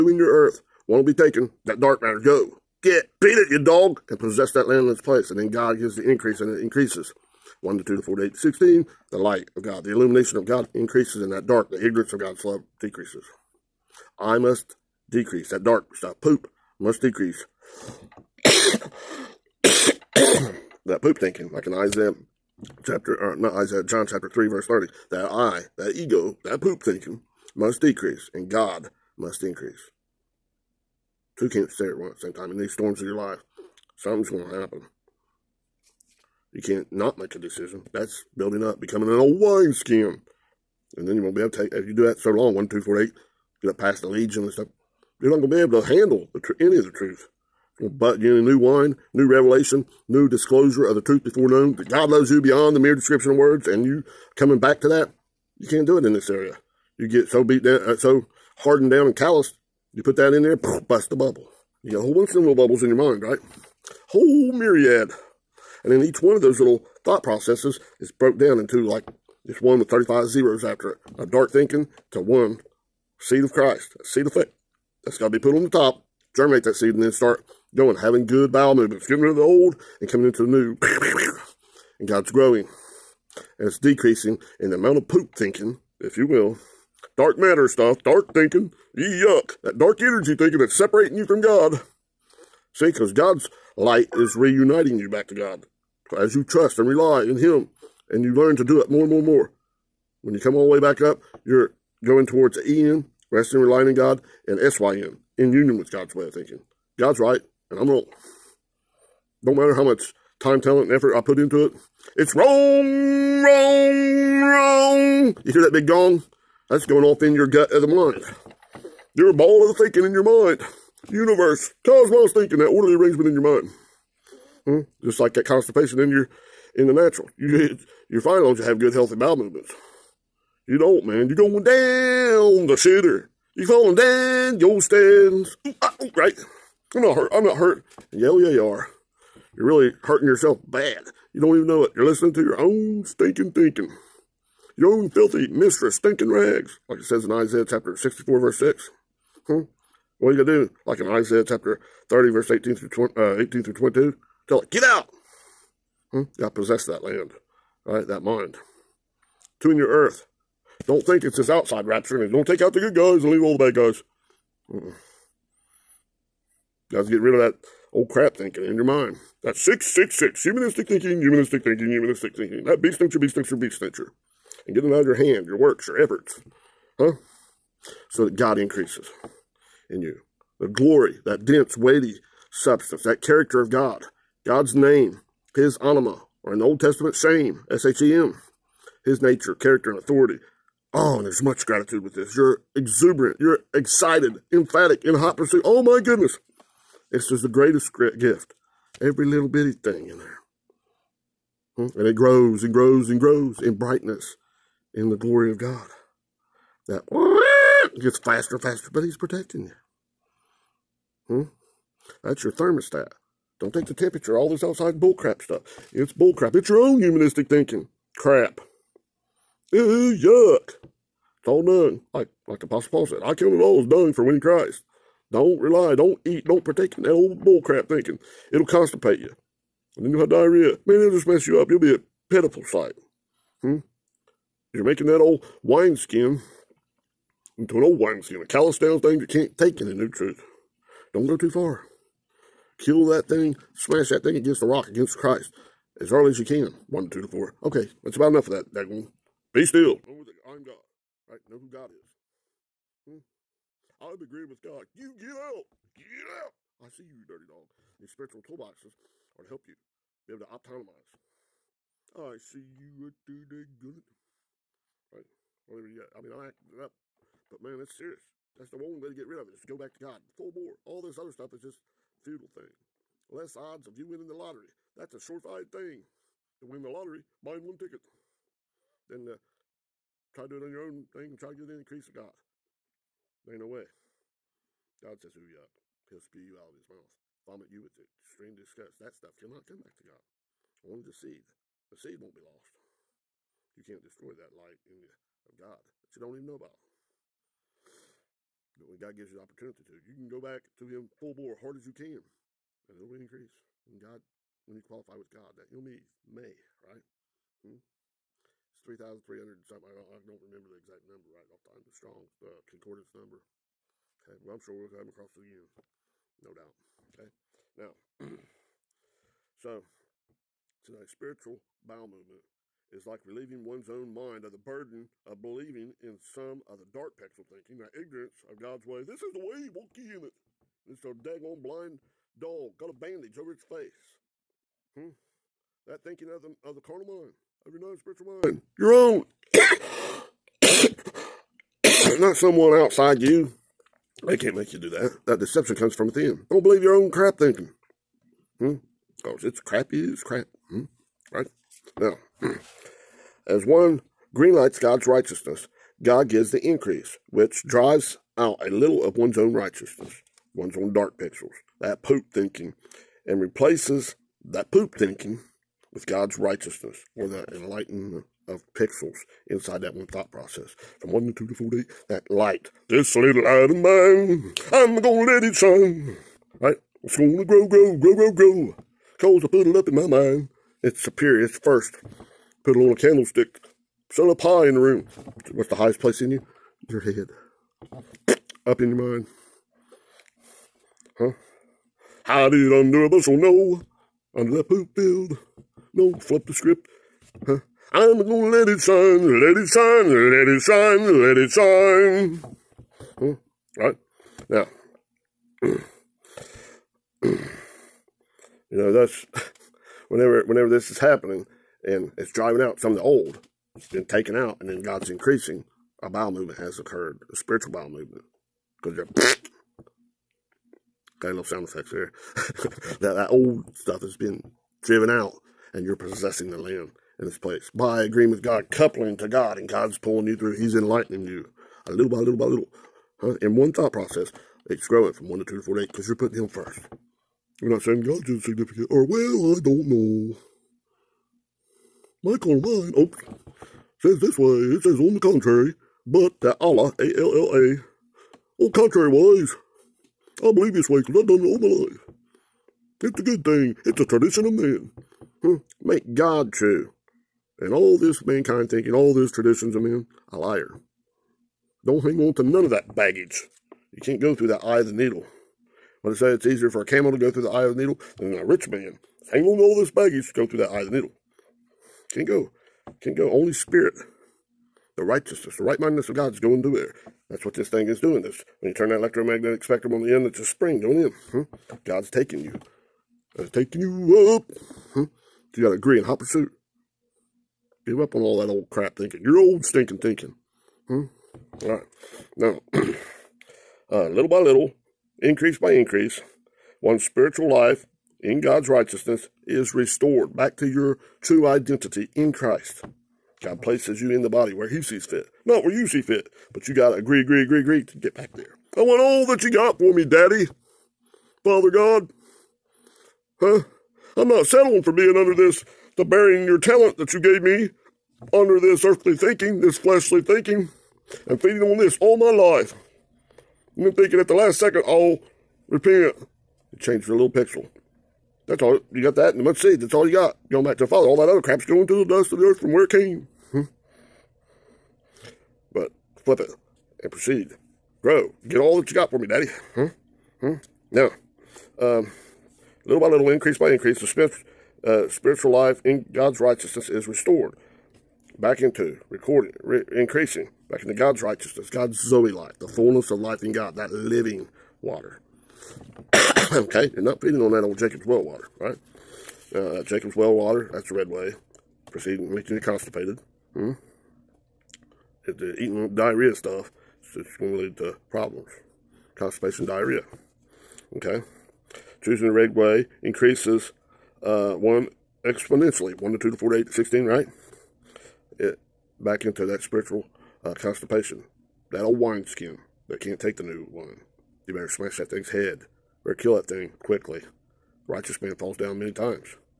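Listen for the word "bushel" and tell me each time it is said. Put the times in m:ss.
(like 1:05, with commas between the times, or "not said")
6:33.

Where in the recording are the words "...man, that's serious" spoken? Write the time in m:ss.
4:27.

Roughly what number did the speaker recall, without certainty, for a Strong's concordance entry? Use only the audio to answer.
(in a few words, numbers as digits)
3,300.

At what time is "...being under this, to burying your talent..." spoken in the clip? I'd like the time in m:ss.
8:34.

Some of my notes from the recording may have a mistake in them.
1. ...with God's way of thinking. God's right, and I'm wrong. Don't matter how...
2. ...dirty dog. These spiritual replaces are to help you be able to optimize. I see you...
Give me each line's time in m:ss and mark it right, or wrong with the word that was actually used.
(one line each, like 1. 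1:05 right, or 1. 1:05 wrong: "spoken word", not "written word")
1. 1:45 right
2. 4:17 wrong: "toolboxes", not "replaces".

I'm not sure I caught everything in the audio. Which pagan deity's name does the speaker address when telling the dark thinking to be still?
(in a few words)
Dagon.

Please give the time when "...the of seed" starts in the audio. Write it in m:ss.
8:49.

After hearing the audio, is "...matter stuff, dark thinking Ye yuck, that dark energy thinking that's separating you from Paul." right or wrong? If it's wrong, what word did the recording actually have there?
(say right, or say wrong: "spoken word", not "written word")
wrong: "God", not "Paul".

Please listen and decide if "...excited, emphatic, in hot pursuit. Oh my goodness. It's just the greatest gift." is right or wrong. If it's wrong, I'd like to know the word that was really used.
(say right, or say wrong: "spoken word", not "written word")
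right.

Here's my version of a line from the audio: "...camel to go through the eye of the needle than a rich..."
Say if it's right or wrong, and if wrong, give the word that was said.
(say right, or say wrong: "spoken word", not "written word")
right.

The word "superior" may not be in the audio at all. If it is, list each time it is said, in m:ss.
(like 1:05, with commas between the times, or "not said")
6:20.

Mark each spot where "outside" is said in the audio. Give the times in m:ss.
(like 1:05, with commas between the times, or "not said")
2:41, 3:34, 5:42.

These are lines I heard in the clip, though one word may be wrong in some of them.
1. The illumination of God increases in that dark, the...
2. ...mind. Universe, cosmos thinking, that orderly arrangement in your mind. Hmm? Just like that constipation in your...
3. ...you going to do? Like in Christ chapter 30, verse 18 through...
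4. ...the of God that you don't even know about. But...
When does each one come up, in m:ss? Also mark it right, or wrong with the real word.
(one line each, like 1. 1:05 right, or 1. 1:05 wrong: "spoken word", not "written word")
1. 0:09 right
2. 2:00 right
3. 2:30 wrong: "Isaiah", not "Christ"
4. 4:55 right.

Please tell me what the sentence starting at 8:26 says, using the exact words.
But you gotta agree, agree, agree, agree to get back there.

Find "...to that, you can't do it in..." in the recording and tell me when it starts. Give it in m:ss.
0:54.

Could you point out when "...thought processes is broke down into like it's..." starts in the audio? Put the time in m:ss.
1:07.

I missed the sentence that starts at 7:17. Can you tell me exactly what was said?
I'm not saying God's insignificant, or well, I don't know.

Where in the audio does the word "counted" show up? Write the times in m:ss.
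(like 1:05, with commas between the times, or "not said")
3:43.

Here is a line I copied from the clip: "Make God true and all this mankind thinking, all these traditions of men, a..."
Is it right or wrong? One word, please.
right.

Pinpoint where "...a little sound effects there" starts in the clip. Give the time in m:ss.
7:01.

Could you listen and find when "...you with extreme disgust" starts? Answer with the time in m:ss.
4:47.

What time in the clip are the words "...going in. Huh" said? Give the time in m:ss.
8:00.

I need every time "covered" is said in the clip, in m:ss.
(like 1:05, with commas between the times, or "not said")
not said.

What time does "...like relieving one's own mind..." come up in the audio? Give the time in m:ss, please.
5:23.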